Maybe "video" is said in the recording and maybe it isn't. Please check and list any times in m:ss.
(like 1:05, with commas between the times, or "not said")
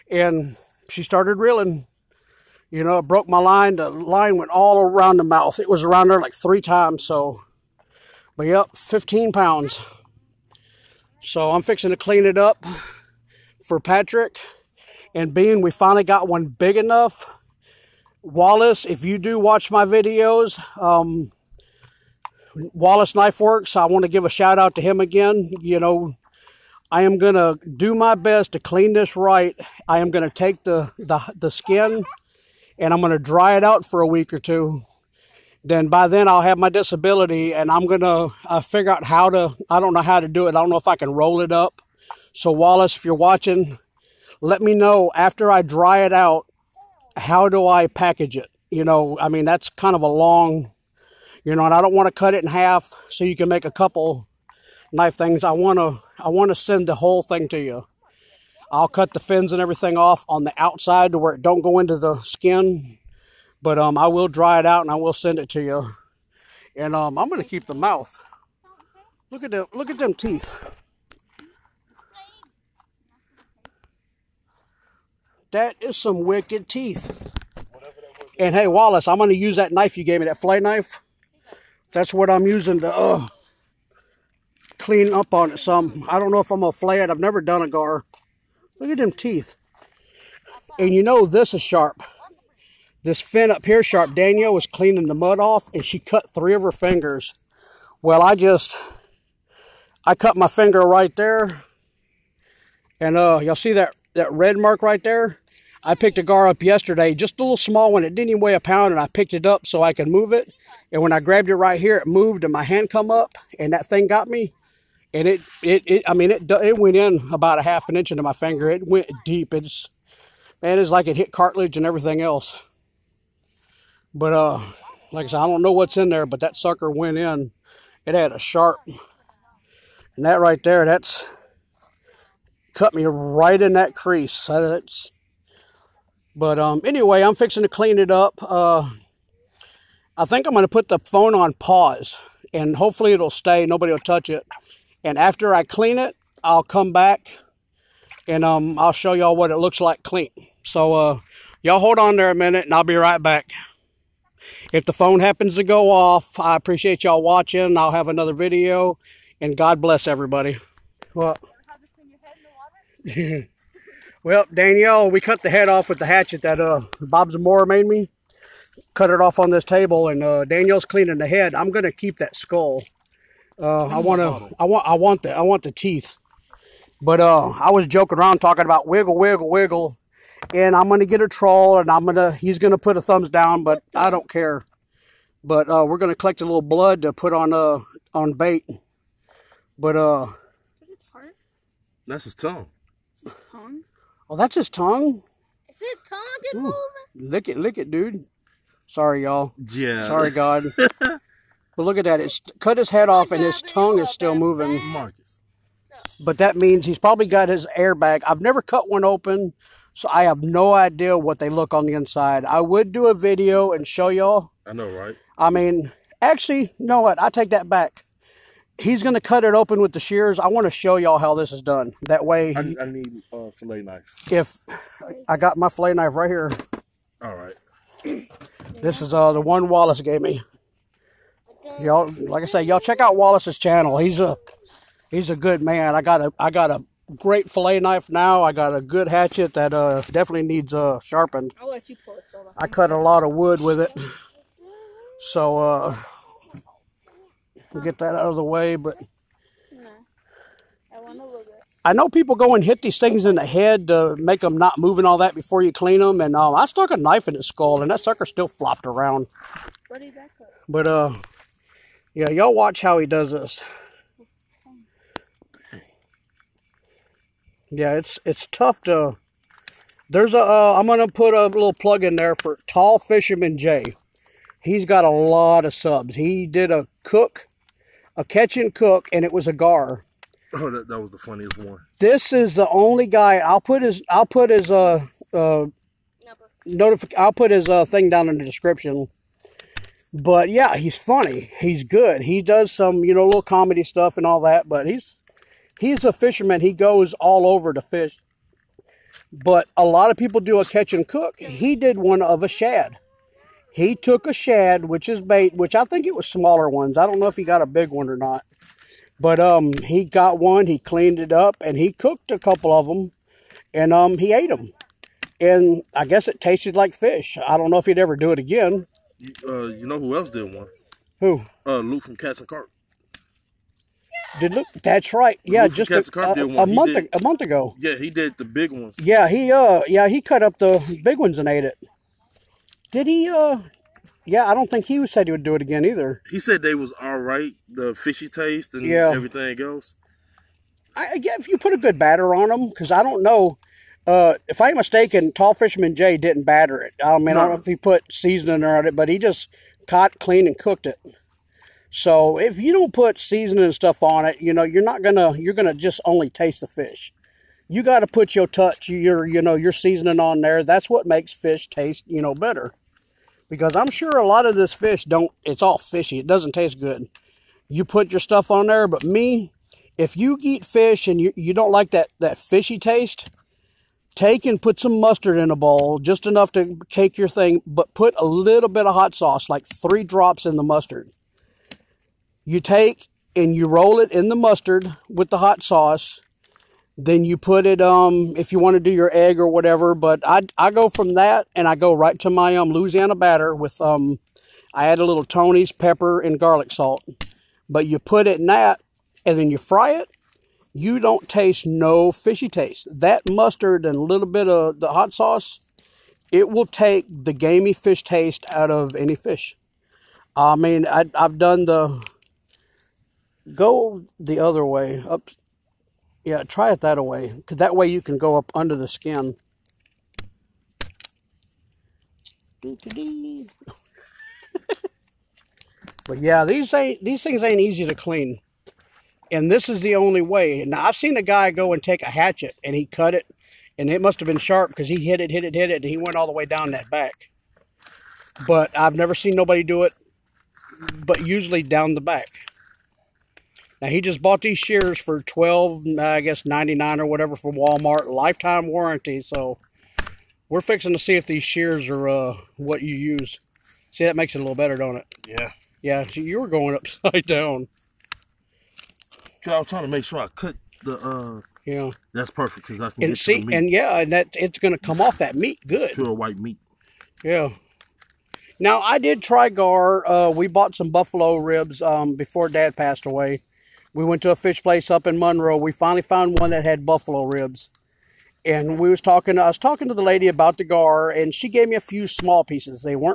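0:19, 2:38, 3:33.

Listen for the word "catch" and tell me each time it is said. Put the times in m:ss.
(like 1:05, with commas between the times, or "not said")
4:38, 5:00.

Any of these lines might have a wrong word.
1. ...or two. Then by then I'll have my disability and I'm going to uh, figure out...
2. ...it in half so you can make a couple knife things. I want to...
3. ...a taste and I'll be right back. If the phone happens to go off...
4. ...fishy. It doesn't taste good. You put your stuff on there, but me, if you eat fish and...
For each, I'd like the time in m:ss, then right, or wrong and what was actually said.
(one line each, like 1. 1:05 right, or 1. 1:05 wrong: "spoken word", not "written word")
1. 0:34 right
2. 0:52 right
3. 2:32 wrong: "minute", not "taste"
4. 6:05 right.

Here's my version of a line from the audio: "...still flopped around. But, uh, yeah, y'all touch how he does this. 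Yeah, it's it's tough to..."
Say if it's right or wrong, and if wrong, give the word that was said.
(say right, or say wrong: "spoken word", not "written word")
wrong: "watch", not "touch".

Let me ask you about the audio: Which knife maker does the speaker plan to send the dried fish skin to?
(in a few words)
Wallace Knife Works.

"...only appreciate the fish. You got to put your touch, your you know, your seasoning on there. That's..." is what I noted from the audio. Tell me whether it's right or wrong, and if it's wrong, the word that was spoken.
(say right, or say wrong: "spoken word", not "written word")
wrong: "taste", not "appreciate".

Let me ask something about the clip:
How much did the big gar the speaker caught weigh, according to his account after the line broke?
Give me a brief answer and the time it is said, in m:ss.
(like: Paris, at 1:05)
15 pounds, at 0:08.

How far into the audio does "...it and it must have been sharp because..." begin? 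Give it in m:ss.
7:13.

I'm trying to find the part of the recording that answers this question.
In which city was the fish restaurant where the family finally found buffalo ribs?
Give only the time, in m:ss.
7:55.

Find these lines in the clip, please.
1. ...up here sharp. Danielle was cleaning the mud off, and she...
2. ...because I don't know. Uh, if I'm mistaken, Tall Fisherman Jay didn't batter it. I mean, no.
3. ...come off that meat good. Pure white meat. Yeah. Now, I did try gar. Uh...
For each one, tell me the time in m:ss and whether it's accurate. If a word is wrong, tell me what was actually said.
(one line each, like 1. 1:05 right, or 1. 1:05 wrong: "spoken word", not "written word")
1. 1:33 right
2. 5:42 right
3. 7:44 right.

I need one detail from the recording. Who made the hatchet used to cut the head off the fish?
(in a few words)
Bob Zamora.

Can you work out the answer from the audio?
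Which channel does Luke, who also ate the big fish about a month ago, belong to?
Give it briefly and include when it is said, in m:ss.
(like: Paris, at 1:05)
Cats and Carp, at 5:22.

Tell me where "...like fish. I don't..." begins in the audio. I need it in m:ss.
5:16.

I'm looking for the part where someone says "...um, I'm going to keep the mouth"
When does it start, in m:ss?
1:06.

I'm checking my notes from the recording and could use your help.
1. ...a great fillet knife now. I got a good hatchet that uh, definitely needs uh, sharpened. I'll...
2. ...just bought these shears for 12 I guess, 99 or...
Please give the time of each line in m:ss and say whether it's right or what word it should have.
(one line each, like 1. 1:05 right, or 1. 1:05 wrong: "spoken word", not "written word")
1. 3:56 right
2. 7:24 right.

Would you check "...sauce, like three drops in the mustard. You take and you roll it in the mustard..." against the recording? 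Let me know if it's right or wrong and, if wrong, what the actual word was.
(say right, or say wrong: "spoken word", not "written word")
right.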